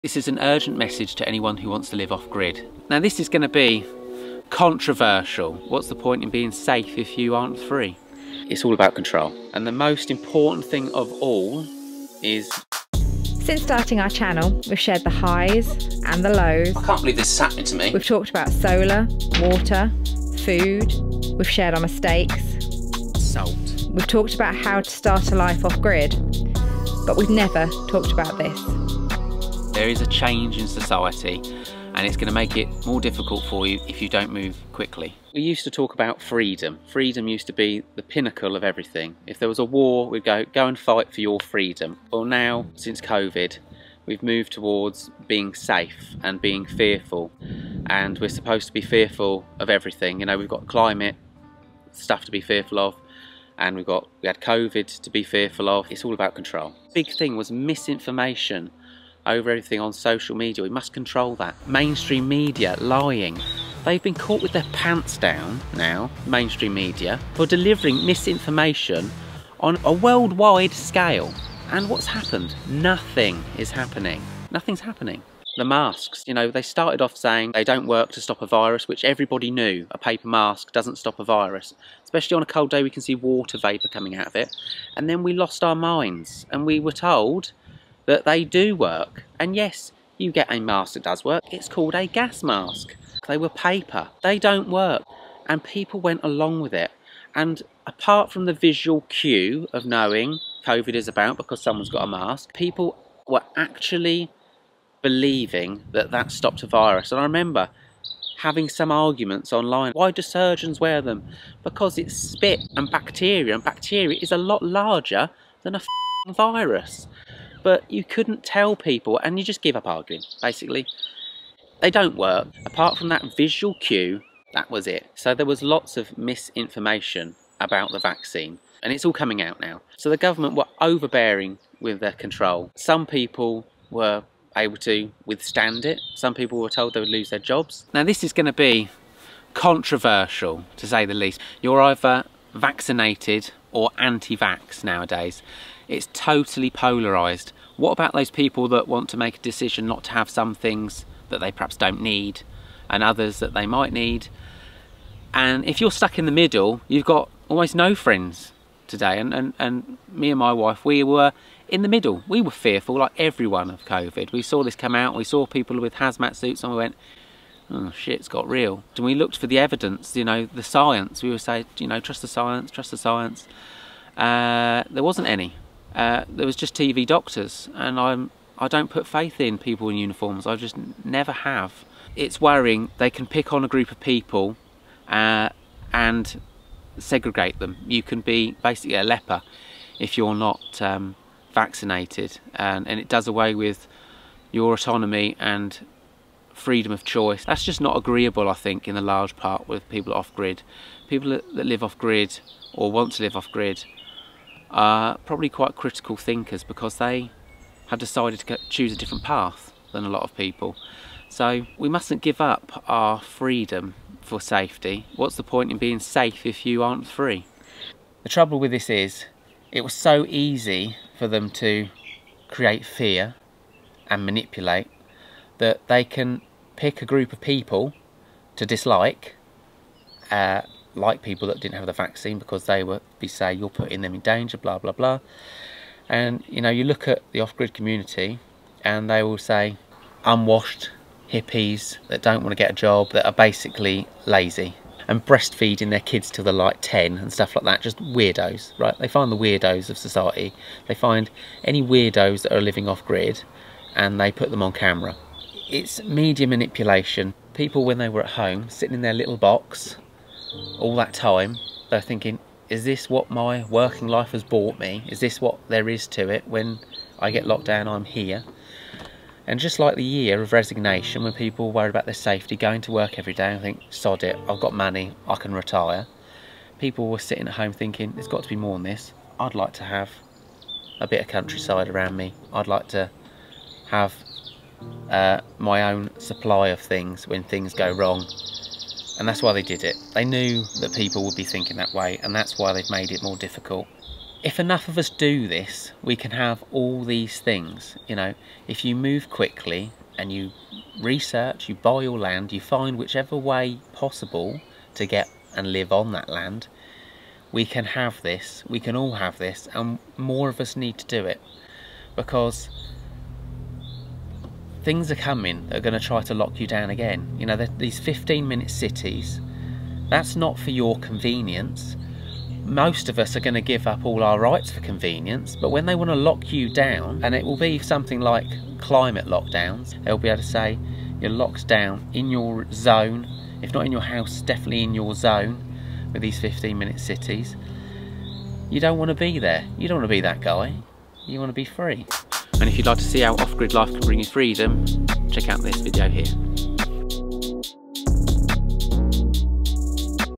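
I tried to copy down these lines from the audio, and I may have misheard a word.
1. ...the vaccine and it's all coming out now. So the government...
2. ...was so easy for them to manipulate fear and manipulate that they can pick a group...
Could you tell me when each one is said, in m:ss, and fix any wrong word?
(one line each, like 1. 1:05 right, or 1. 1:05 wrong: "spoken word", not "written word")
1. 2:07 right
2. 3:39 wrong: "create", not "manipulate".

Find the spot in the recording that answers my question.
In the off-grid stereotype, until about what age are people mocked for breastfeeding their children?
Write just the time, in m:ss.
4:06.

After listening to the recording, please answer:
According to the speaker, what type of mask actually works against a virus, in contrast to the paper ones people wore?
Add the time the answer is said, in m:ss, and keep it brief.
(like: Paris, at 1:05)
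gas mask, at 1:32.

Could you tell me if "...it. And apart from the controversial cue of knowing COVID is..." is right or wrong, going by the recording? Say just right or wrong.
wrong.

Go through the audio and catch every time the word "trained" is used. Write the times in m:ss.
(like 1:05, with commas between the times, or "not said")
not said.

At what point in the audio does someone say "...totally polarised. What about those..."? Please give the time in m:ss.
2:26.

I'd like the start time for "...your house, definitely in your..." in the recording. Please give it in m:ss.
5:33.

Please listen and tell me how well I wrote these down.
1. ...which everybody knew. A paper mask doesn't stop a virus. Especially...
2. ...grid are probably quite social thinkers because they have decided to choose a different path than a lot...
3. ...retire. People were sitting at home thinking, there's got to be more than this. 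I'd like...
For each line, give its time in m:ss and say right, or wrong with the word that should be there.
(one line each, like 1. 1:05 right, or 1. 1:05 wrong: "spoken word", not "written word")
1. 1:18 right
2. 3:23 wrong: "critical", not "social"
3. 4:35 right.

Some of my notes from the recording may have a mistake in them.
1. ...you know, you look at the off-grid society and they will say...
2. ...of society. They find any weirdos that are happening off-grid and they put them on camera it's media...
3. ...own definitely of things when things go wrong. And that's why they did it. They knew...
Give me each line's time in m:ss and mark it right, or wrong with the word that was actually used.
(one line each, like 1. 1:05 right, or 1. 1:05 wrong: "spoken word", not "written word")
1. 3:56 wrong: "community", not "society"
2. 4:09 wrong: "living", not "happening"
3. 4:45 wrong: "supply", not "definitely".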